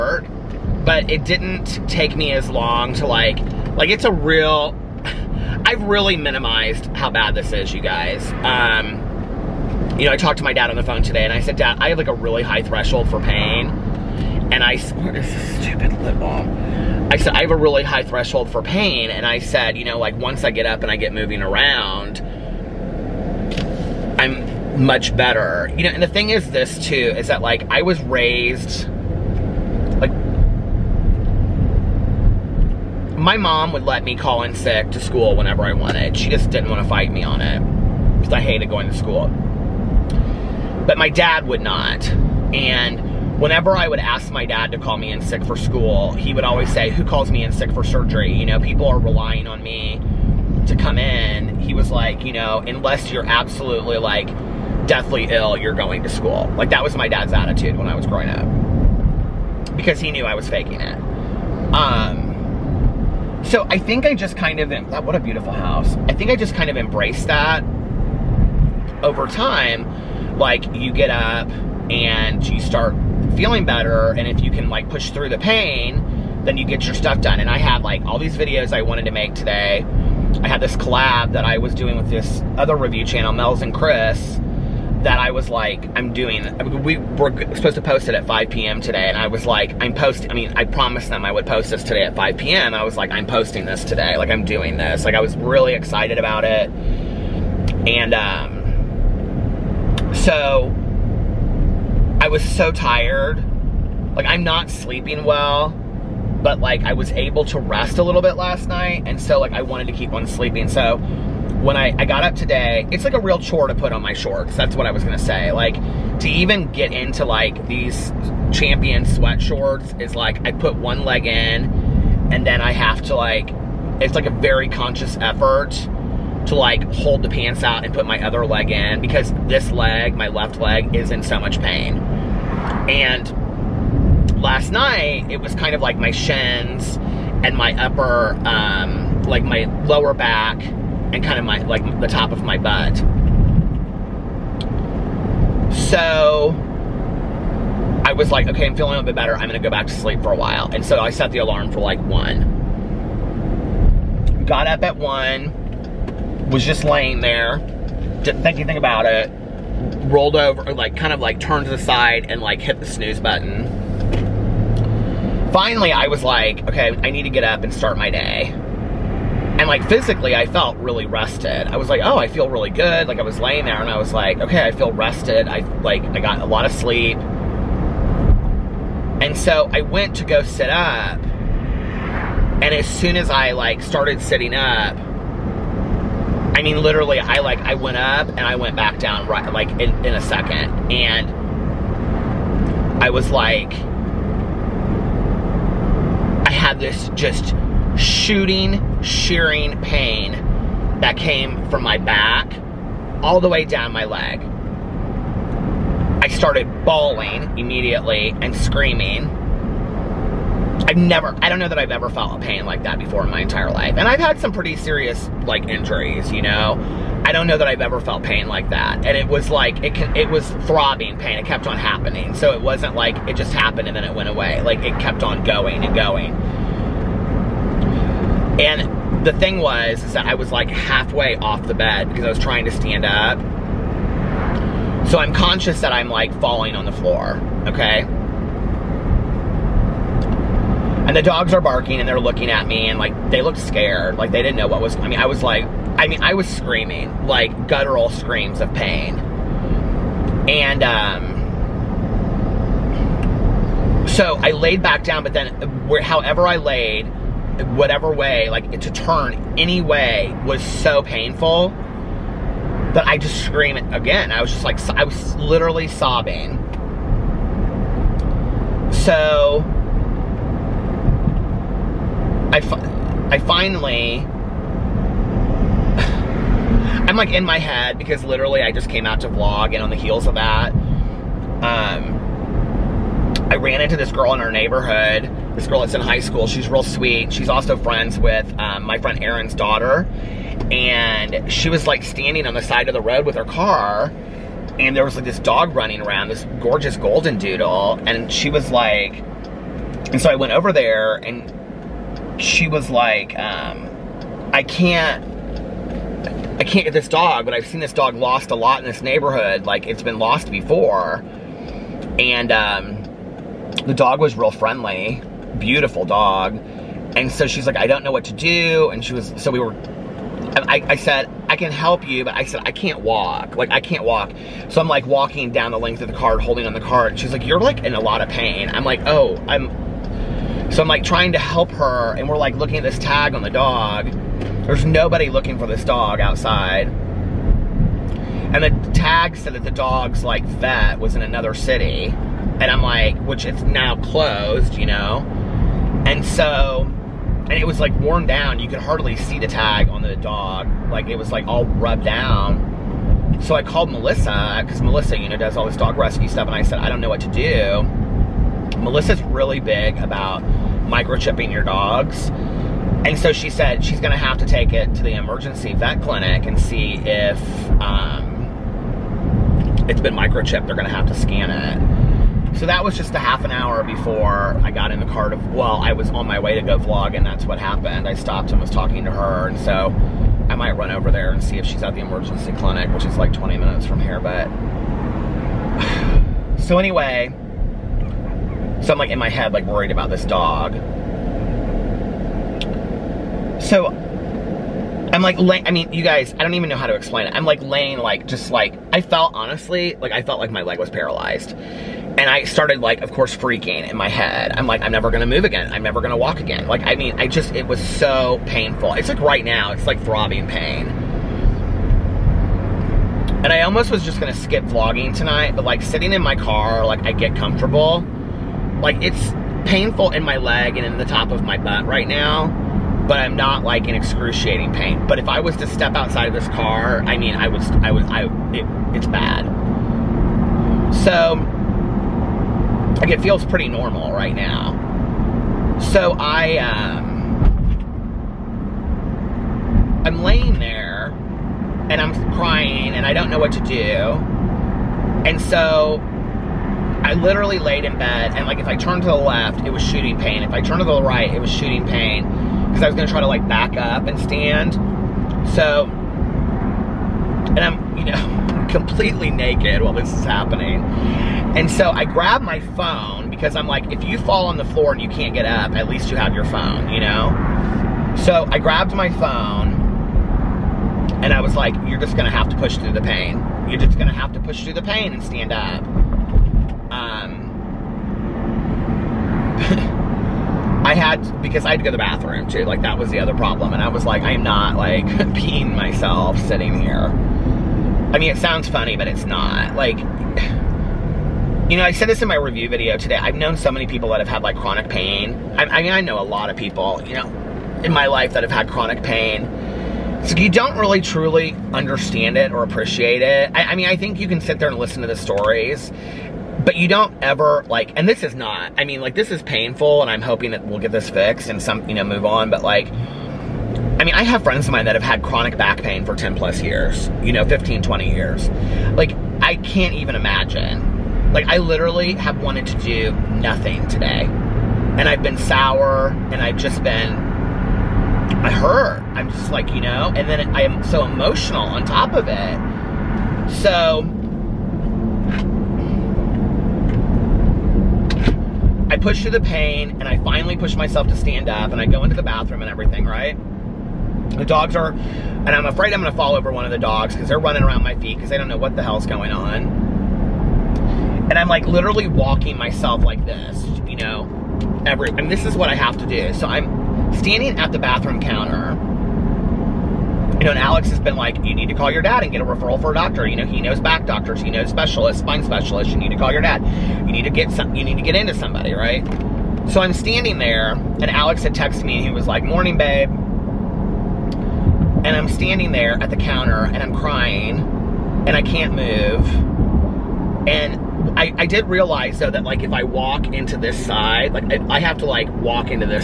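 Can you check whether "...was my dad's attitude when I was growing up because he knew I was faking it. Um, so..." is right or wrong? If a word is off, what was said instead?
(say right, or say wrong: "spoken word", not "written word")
right.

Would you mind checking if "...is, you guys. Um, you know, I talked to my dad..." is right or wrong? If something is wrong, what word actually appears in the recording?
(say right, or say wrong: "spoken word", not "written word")
right.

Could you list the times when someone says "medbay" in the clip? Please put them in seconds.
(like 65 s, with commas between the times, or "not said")
not said.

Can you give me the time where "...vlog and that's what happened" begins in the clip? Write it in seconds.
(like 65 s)
376 s.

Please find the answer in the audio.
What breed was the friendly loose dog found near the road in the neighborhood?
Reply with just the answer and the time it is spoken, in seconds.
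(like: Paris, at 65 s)
golden doodle, at 296 s.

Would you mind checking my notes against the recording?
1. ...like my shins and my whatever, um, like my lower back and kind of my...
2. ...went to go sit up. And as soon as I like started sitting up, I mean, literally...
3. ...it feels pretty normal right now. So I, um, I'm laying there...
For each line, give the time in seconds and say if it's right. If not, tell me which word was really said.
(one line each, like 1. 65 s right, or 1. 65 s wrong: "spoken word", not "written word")
1. 135 s wrong: "upper", not "whatever"
2. 179 s right
3. 433 s right.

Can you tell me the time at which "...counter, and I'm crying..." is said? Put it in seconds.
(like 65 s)
576 s.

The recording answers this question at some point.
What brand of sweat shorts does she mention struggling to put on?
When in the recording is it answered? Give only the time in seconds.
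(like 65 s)
118 s.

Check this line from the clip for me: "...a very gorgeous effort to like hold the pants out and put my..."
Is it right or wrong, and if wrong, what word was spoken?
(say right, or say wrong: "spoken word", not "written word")
wrong: "conscious", not "gorgeous".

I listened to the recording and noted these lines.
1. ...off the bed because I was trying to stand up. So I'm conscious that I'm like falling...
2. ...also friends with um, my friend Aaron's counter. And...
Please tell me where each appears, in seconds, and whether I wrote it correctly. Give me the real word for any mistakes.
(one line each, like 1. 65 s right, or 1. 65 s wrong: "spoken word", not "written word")
1. 231 s right
2. 287 s wrong: "daughter", not "counter".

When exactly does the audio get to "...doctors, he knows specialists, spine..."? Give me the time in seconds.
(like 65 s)
564 s.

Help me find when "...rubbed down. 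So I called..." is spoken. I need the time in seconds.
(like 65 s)
351 s.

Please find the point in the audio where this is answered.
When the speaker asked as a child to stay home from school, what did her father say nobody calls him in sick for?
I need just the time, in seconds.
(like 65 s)
47 s.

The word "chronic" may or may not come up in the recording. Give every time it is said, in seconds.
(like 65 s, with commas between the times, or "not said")
494 s, 498 s, 515 s.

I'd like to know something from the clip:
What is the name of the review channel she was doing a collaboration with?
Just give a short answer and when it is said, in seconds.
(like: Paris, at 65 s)
Mel's and Chris, at 83 s.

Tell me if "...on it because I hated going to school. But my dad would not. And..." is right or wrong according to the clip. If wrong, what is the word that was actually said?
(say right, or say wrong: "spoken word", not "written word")
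right.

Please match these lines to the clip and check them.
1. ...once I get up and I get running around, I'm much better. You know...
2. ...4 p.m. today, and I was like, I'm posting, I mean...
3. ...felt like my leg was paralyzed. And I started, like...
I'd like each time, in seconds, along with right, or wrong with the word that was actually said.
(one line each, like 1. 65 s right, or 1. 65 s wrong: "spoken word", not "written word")
1. 20 s wrong: "moving", not "running"
2. 88 s wrong: "5", not "4"
3. 400 s right.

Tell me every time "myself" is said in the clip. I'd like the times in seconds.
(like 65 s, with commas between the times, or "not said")
485 s, 540 s, 552 s.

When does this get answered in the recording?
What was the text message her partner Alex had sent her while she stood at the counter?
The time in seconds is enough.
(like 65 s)
572 s.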